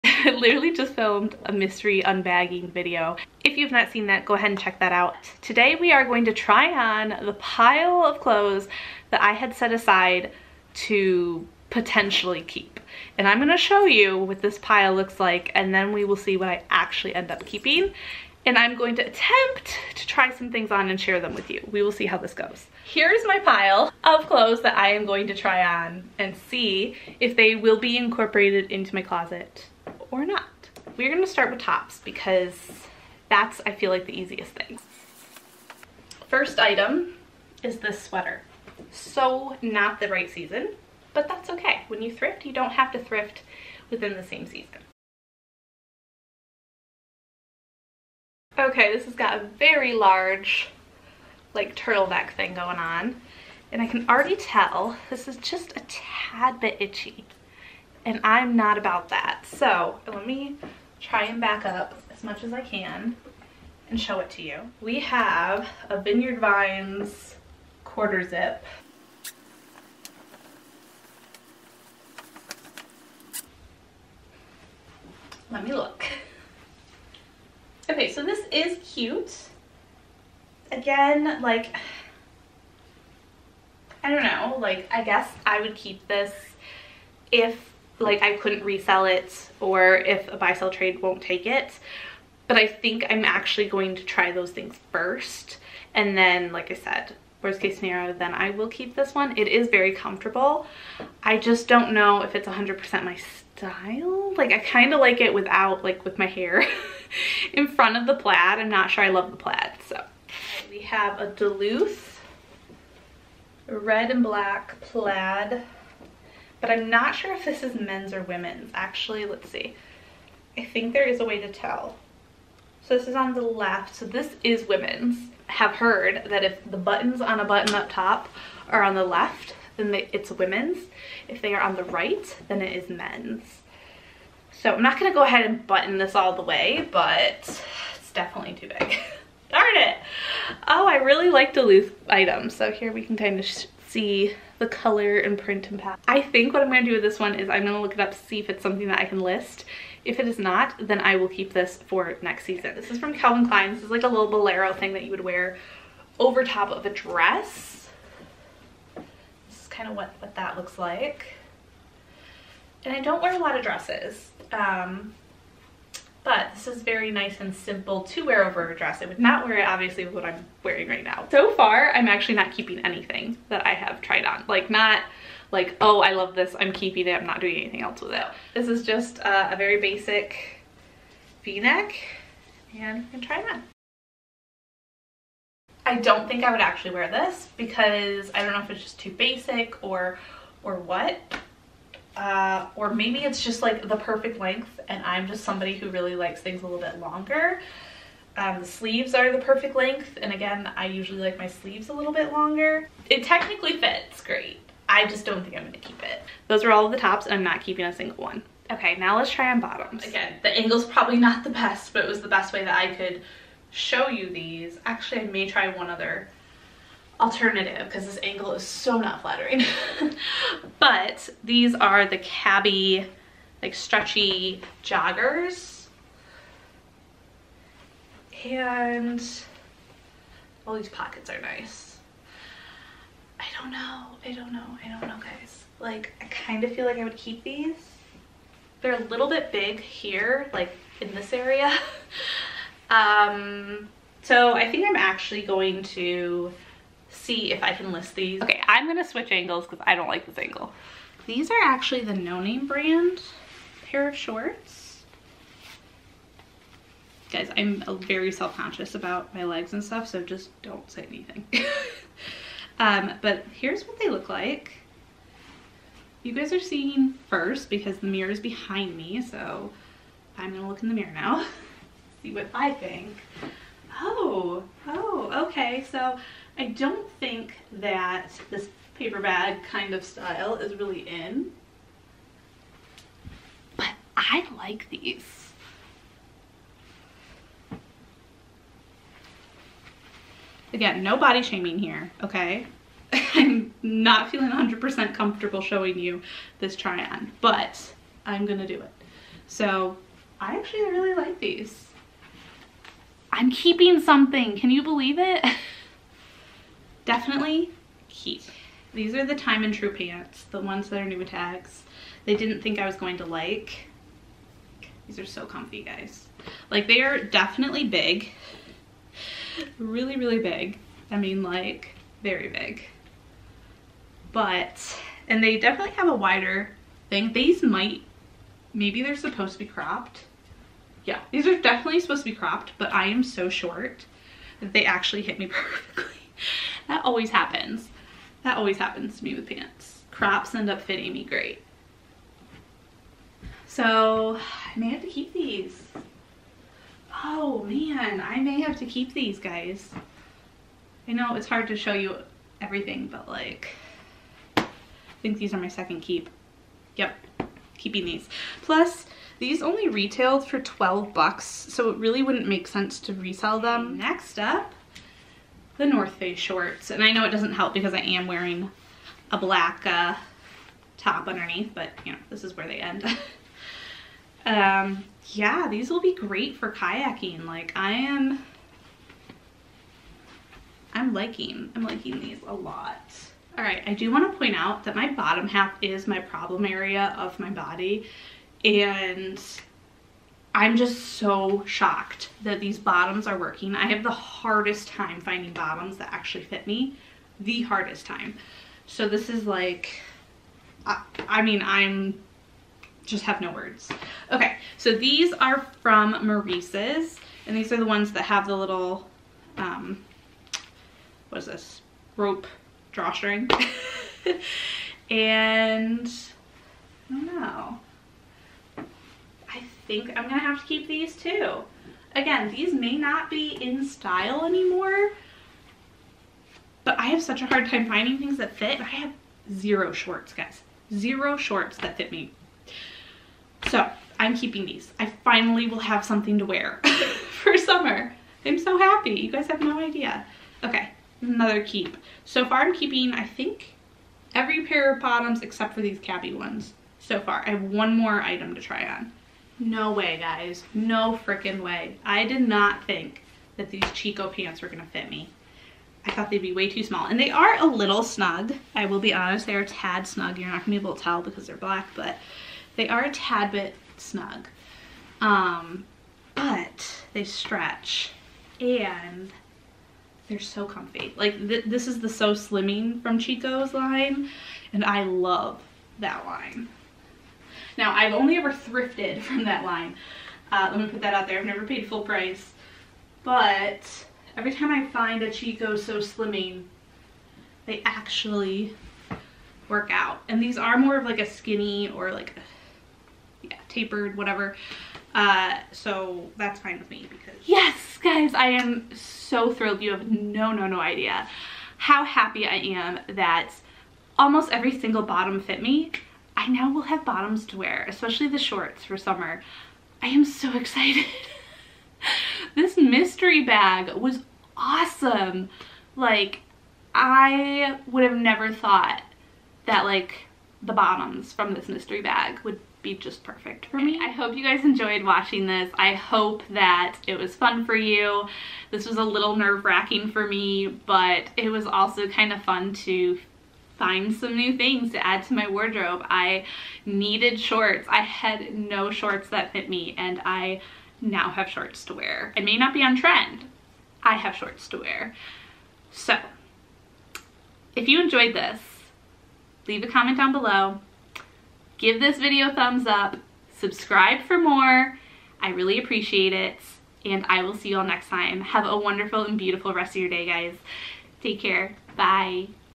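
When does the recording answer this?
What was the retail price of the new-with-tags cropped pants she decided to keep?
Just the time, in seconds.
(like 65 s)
360 s.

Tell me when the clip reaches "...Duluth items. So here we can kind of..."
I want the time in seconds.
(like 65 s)
141 s.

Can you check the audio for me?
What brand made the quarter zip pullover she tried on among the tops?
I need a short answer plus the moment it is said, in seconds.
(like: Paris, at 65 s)
Vineyard Vines, at 66 s.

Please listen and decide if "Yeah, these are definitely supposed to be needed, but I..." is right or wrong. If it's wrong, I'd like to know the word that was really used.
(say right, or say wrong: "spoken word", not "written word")
wrong: "cropped", not "needed".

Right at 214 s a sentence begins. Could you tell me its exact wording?
Actually, I may try one other alternative because this angle is so not flattering.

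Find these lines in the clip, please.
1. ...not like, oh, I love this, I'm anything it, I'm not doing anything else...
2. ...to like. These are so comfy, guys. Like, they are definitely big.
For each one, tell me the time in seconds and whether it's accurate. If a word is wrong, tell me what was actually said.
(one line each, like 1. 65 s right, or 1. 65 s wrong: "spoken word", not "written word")
1. 174 s wrong: "keeping", not "anything"
2. 313 s right.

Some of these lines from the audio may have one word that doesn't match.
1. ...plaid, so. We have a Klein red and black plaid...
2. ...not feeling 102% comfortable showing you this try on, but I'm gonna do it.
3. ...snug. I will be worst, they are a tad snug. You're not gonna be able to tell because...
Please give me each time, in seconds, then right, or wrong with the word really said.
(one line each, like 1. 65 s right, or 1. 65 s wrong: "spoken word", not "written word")
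1. 109 s wrong: "Duluth", not "Klein"
2. 293 s wrong: "100", not "102"
3. 458 s wrong: "honest", not "worst".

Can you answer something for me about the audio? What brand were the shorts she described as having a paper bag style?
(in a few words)
No Name.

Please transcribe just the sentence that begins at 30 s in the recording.
We're gonna start with tops because that's, I feel like, the easiest thing.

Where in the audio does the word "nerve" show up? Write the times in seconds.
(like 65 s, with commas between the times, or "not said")
529 s.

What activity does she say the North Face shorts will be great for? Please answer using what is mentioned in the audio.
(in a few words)
Kayaking.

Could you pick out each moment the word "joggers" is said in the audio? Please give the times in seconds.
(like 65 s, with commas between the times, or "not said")
224 s.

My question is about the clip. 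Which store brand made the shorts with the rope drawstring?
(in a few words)
Maurices.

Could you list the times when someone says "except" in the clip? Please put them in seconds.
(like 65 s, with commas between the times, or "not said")
445 s.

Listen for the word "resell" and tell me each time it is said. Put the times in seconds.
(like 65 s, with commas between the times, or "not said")
88 s, 363 s.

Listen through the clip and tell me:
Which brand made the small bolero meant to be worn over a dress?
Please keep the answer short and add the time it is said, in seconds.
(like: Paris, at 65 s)
Calvin Klein, at 153 s.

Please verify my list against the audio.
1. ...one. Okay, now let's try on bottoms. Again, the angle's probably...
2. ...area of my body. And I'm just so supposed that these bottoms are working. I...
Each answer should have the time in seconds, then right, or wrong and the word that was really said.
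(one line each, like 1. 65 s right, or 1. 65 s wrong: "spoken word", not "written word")
1. 208 s right
2. 386 s wrong: "shocked", not "supposed".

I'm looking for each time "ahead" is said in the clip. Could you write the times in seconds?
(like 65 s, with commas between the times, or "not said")
4 s, 135 s.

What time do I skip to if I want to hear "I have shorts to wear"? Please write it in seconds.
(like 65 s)
544 s.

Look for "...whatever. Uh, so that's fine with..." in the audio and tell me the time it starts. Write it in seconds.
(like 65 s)
494 s.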